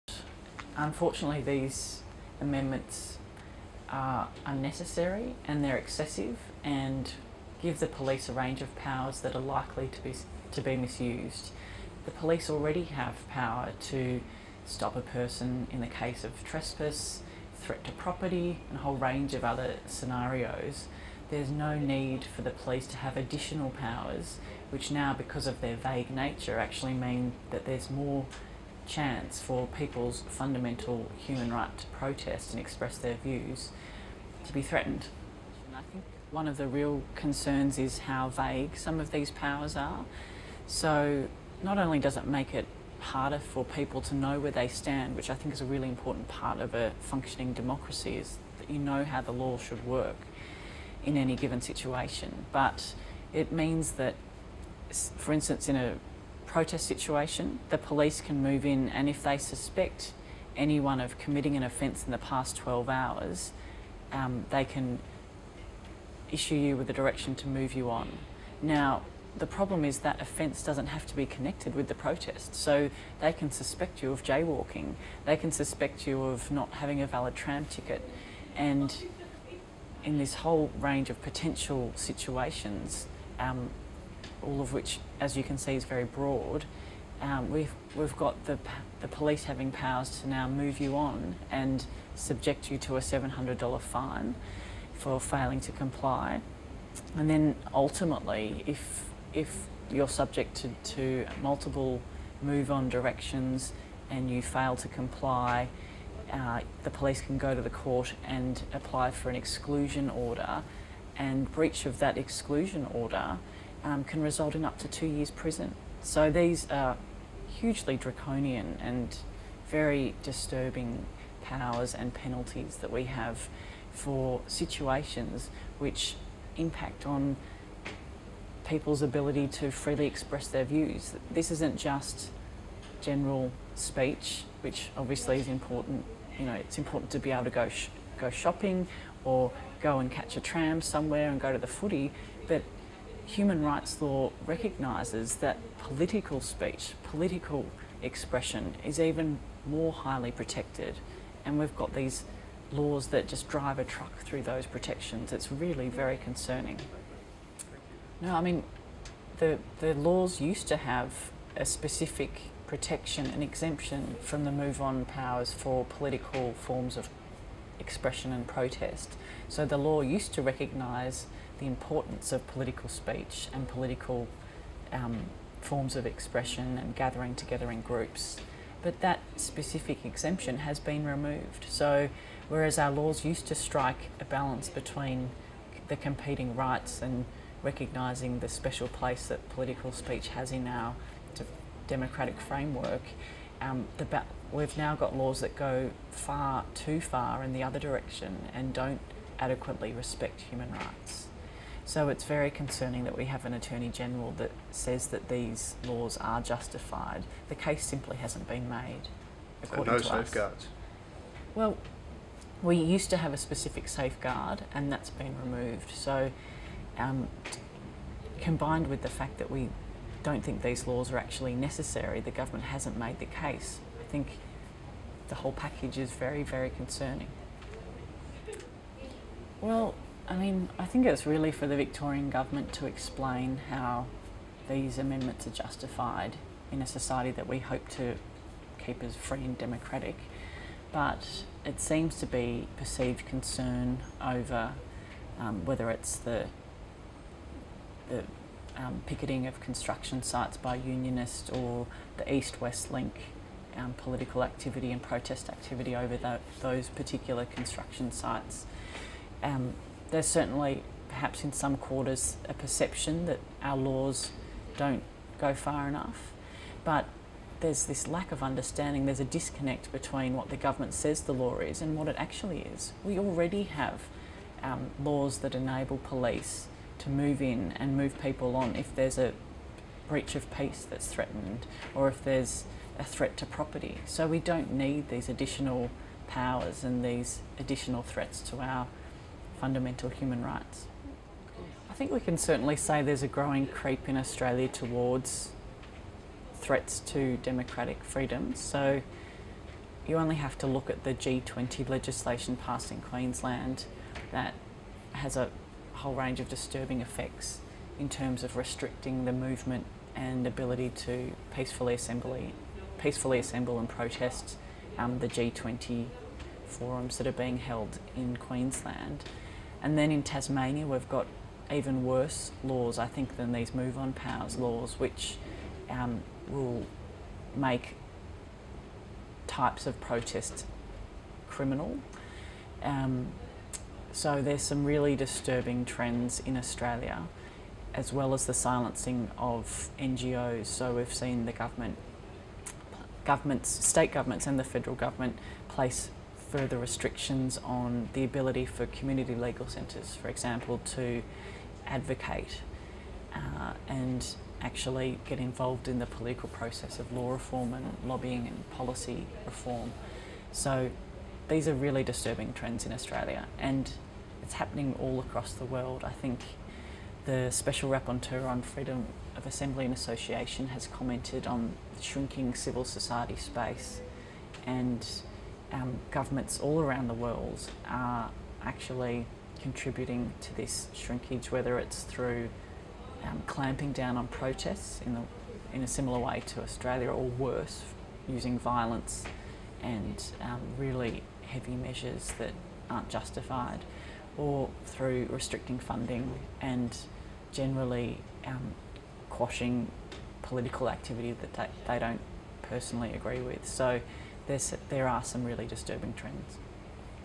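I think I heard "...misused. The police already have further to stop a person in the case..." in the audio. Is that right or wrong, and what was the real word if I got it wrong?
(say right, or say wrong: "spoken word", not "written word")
wrong: "power", not "further".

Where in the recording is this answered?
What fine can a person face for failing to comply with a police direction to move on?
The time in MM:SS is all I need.
01:33.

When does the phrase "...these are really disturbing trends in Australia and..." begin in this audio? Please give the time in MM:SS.
06:01.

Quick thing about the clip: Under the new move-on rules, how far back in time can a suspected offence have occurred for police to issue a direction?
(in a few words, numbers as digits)
12 hours.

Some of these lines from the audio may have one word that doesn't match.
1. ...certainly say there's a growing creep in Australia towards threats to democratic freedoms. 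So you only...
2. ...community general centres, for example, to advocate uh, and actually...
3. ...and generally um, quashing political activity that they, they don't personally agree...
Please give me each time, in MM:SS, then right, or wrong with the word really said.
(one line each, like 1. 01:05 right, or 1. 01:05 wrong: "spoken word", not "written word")
1. 04:52 right
2. 05:48 wrong: "legal", not "general"
3. 06:36 right.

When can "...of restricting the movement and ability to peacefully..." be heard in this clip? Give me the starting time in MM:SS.
05:08.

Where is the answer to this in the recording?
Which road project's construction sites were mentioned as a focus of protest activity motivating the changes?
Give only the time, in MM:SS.
04:12.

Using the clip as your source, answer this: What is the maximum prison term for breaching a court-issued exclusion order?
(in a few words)
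2 years.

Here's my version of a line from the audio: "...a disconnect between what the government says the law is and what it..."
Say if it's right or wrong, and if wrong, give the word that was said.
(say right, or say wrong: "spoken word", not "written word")
right.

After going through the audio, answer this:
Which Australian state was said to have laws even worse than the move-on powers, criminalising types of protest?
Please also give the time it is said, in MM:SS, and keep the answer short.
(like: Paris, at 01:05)
Tasmania, at 05:20.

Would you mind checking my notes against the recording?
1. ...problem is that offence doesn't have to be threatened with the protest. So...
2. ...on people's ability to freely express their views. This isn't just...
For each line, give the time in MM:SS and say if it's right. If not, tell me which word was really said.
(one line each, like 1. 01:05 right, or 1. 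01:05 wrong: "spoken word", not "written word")
1. 01:09 wrong: "connected", not "threatened"
2. 02:07 right.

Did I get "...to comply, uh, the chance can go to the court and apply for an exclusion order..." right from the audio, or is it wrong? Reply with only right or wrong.
wrong.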